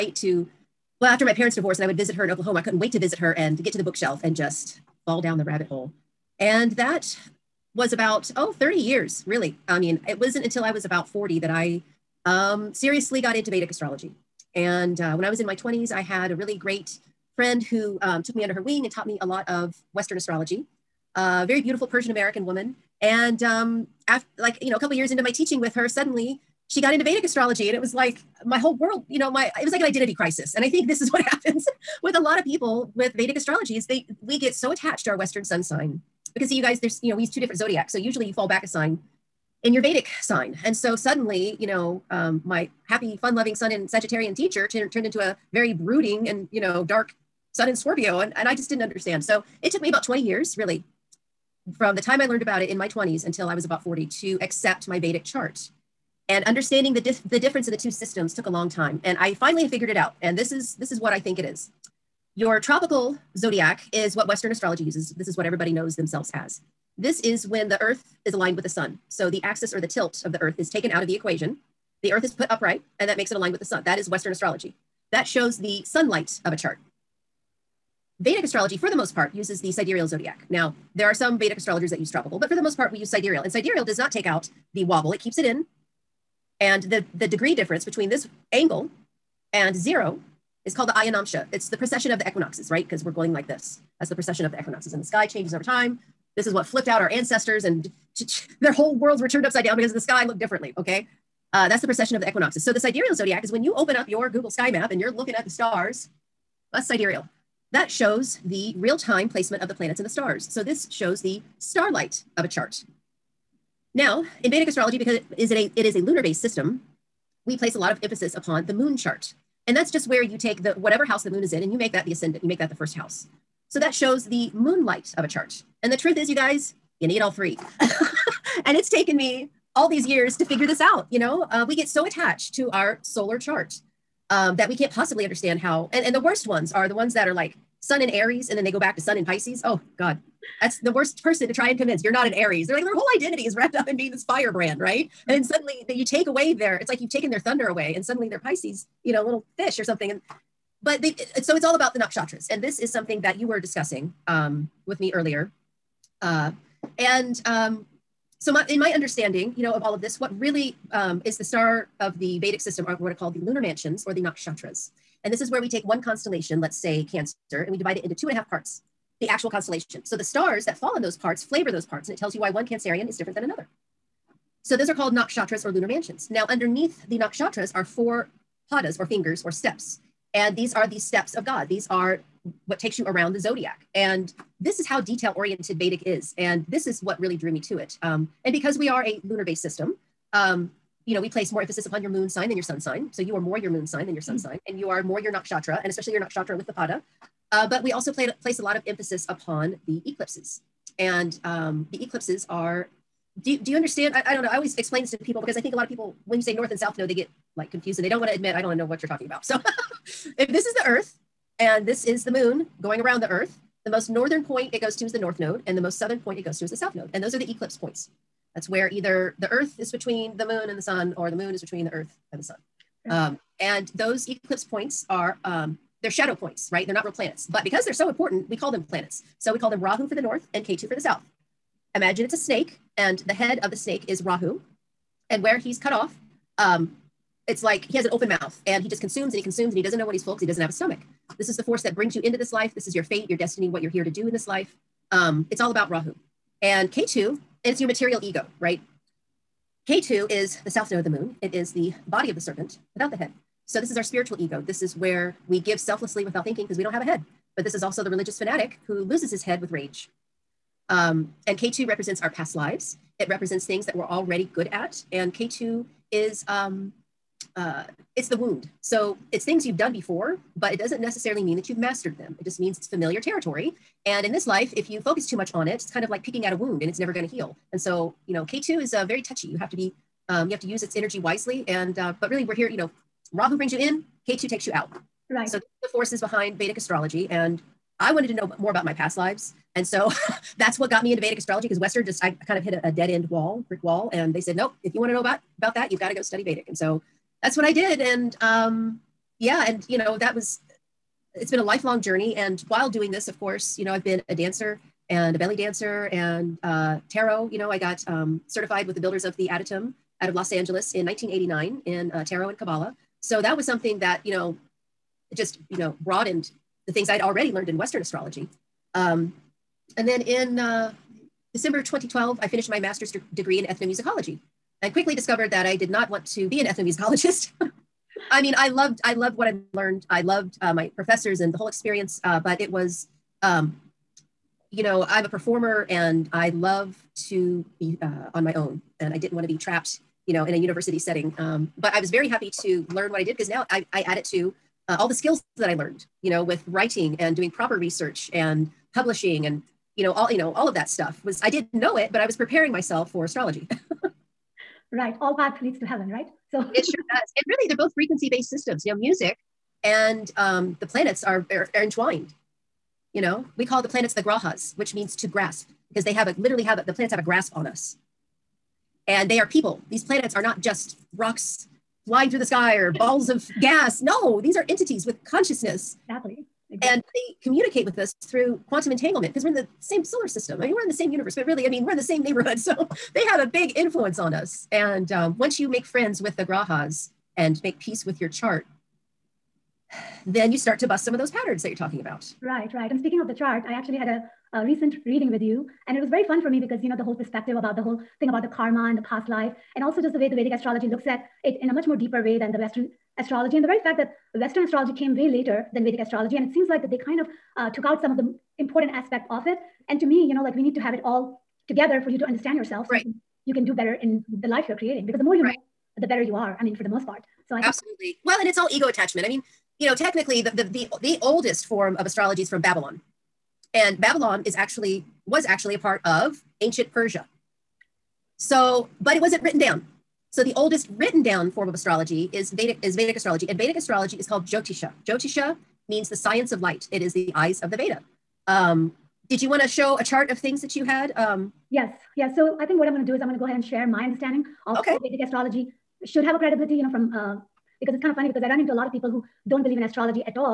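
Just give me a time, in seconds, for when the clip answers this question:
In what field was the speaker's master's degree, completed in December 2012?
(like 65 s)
323 s.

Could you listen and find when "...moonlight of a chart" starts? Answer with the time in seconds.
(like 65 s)
124 s.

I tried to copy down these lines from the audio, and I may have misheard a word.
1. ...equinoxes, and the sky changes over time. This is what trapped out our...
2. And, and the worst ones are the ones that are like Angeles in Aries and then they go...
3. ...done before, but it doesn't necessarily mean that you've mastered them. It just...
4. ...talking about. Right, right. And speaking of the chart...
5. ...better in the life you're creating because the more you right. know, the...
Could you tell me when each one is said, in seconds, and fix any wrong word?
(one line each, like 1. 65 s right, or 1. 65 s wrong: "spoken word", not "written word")
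1. 94 s wrong: "flipped", not "trapped"
2. 135 s wrong: "Sun", not "Angeles"
3. 269 s right
4. 391 s right
5. 413 s right.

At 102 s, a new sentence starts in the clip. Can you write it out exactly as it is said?
So the sidereal zodiac is when you open up your Google sky map and you're looking at the stars, that's sidereal.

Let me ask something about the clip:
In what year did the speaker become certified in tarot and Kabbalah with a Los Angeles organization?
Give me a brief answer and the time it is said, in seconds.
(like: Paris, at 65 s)
1989, at 311 s.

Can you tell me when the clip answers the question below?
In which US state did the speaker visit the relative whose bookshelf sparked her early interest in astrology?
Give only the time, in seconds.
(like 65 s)
2 s.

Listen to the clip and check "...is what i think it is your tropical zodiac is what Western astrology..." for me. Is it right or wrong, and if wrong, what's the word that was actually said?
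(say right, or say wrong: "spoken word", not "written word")
right.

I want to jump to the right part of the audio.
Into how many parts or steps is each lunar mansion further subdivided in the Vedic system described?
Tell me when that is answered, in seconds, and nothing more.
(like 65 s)
177 s.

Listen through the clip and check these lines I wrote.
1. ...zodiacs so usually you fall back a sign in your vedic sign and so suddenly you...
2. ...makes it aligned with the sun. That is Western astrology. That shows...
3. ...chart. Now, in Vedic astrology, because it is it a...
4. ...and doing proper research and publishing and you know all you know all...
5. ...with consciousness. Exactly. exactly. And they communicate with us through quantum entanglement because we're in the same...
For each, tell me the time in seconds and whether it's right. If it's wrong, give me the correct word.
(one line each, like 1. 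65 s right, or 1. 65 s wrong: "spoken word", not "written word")
1. 37 s right
2. 73 s right
3. 112 s right
4. 347 s right
5. 375 s right.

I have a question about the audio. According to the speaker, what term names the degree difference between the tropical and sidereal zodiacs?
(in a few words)
Ayanamsha.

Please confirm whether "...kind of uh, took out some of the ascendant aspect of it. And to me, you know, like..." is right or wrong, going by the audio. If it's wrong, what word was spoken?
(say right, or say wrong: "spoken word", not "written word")
wrong: "important", not "ascendant".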